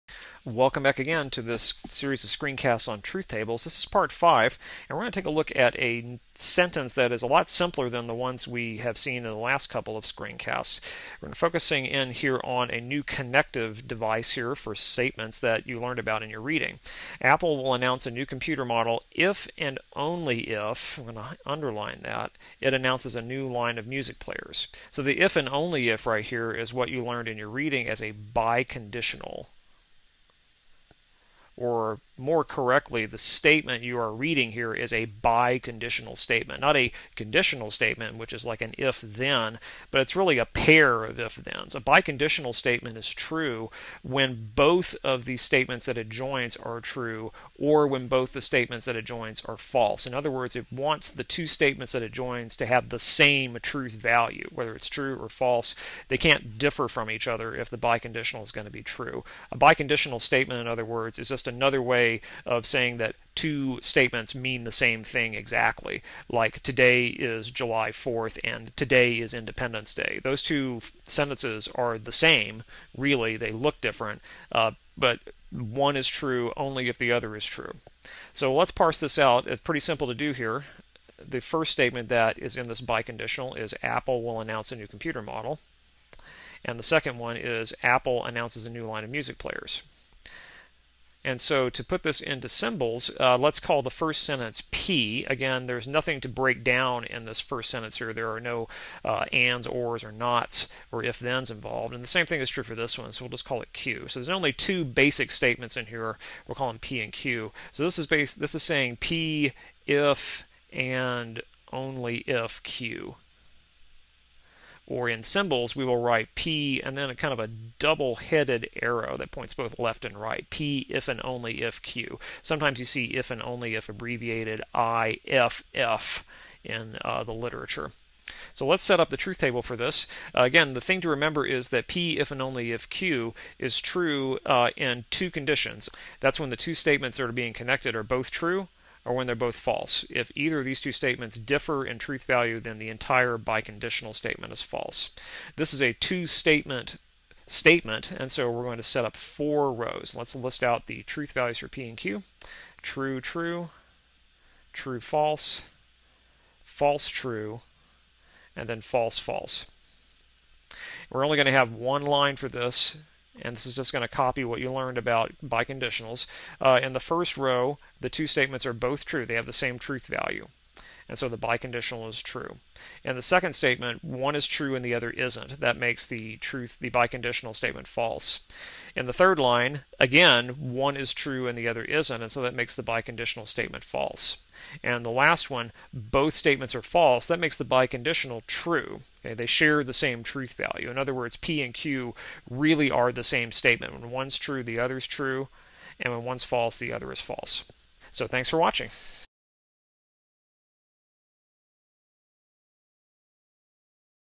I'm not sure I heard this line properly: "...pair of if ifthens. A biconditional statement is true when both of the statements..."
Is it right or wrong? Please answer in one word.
wrong.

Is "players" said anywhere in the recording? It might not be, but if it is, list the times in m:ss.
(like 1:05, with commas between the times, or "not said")
0:24, 1:29.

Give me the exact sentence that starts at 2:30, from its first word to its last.
Let's list out the truth values for P and Q.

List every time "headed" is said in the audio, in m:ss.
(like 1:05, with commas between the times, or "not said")
1:57.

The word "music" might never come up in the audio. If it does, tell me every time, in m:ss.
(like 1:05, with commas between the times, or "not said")
0:23, 1:29.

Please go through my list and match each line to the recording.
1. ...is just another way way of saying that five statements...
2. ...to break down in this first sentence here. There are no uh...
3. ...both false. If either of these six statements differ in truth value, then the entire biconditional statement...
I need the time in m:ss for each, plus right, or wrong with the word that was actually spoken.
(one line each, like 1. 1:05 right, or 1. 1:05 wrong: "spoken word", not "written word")
1. 1:01 wrong: "two", not "five"
2. 1:36 right
3. 2:19 wrong: "two", not "six".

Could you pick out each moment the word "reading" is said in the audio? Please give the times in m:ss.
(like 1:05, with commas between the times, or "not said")
0:16, 0:27, 0:34.